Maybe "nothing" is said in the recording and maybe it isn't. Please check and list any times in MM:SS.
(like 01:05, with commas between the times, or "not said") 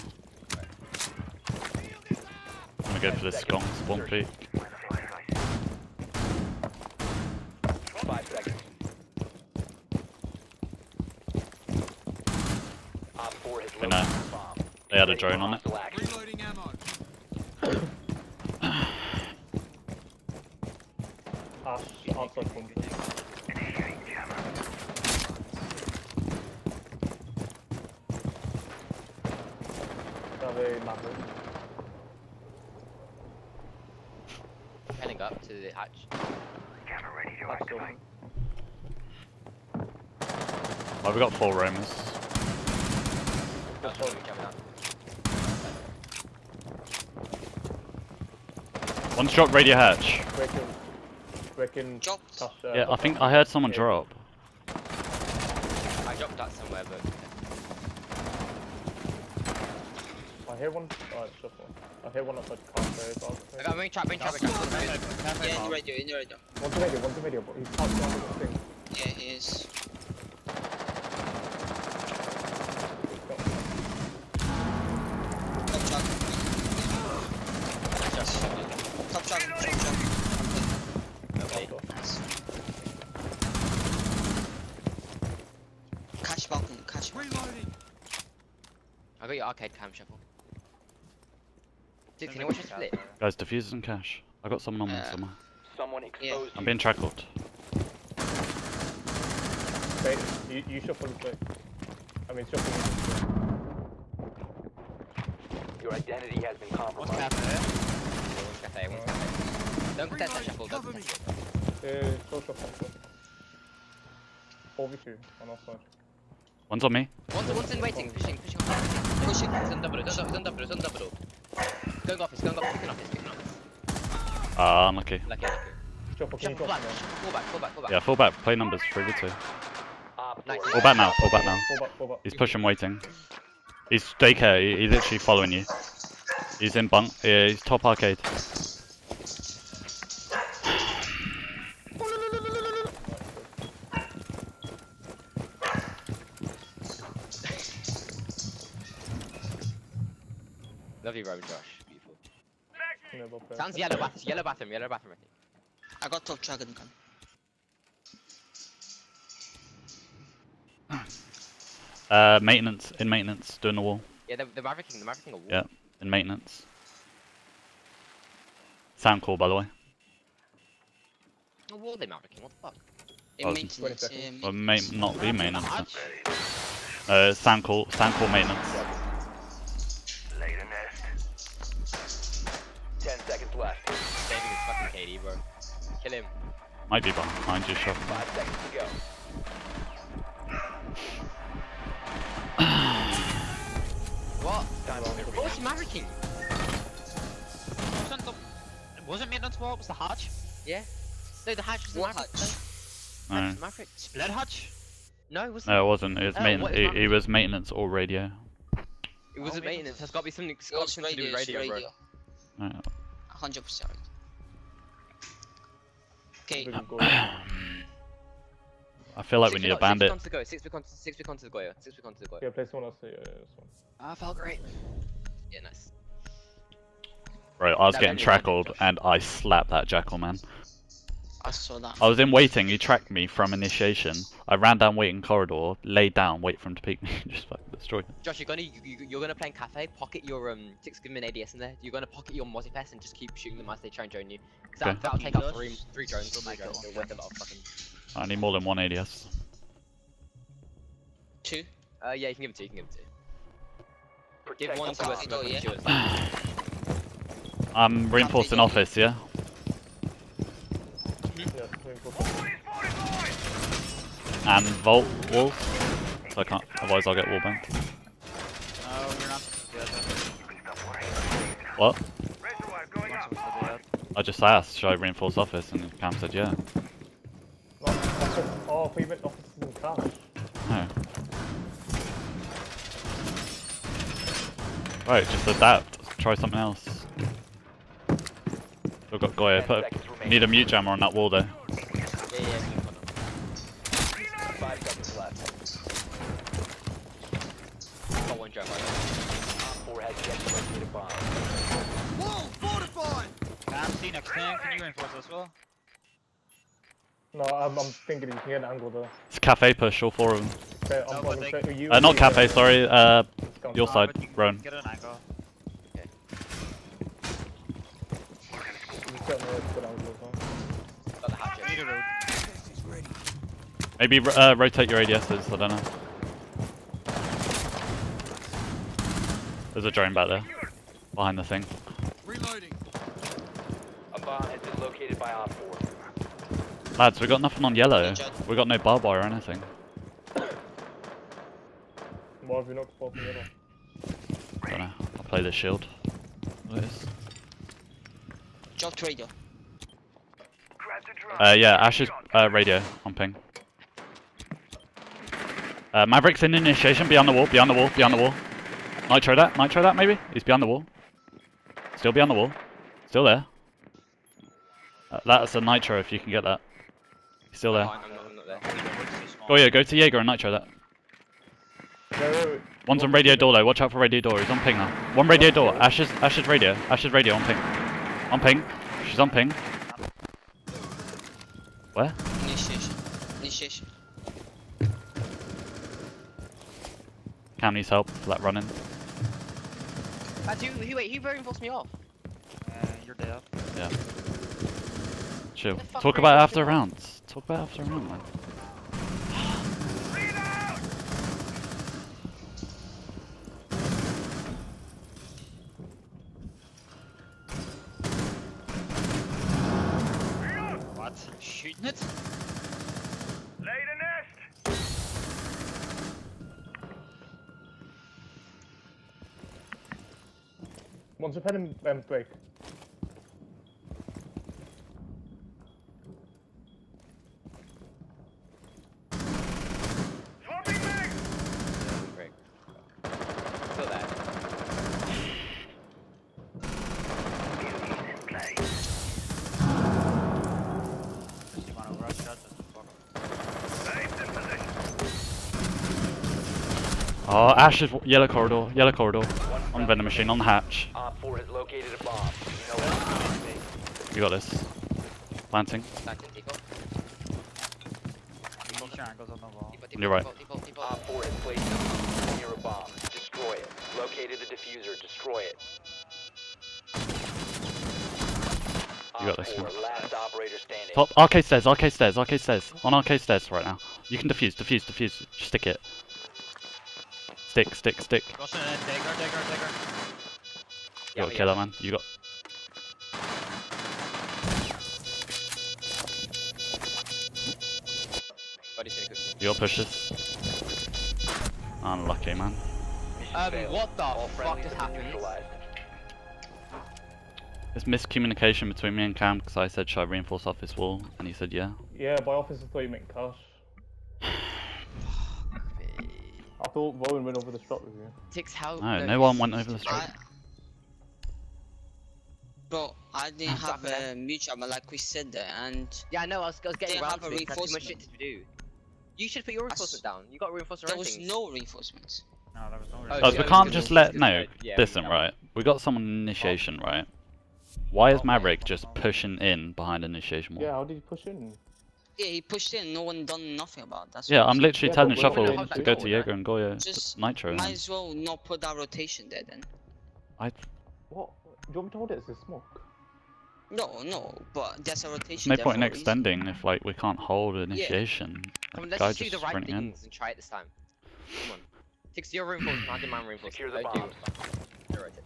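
05:37, 08:53.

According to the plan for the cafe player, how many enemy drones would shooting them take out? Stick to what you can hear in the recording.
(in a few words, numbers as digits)
3.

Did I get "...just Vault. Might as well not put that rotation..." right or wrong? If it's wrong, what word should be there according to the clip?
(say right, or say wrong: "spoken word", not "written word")
wrong: "Nitro", not "Vault".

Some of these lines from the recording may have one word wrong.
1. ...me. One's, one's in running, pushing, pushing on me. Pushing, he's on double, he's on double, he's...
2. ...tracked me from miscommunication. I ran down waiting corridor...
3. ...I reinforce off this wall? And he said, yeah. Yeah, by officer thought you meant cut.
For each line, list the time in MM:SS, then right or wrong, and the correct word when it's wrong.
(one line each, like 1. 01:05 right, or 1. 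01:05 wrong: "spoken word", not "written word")
1. 01:56 wrong: "waiting", not "running"
2. 03:52 wrong: "initiation", not "miscommunication"
3. 08:19 right.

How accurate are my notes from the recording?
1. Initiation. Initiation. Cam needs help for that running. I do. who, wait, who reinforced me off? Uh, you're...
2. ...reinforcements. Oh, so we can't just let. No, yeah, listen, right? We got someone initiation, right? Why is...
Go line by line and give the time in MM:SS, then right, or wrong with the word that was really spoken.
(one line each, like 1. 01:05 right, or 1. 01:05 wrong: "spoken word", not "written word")
1. 06:22 right
2. 08:42 right.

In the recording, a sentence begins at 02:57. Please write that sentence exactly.
Uh, sound call, sound call maintenance.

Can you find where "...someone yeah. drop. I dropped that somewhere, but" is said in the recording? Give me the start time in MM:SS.
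00:53.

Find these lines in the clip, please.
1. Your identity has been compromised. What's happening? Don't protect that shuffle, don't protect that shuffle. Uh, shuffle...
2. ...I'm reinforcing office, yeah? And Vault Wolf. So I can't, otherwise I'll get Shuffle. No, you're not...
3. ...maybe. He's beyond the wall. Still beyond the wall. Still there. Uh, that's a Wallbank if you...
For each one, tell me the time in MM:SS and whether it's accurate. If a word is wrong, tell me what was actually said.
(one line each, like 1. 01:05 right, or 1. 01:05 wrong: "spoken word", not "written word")
1. 01:45 right
2. 04:17 wrong: "Wallbank", not "Shuffle"
3. 05:59 wrong: "Nitro", not "Wallbank".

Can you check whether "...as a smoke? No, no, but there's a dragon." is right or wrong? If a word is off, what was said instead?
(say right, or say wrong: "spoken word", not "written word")
wrong: "rotation", not "dragon".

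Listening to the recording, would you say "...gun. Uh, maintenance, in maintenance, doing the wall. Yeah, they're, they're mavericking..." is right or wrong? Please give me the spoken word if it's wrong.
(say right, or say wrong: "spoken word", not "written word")
right.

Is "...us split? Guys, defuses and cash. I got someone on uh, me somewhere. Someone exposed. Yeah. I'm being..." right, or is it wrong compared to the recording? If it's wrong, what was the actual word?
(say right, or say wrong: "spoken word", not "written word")
right.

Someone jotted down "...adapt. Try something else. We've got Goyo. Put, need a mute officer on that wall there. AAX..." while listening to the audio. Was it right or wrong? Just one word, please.
wrong.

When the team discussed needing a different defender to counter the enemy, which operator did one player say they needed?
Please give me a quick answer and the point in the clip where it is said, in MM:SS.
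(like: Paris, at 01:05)
Bandit, at 03:39.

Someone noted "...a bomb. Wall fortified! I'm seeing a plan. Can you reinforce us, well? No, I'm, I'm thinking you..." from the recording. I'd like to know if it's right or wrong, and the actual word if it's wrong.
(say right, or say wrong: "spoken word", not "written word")
right.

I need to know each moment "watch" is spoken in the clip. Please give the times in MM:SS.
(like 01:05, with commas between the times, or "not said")
01:32, 06:13.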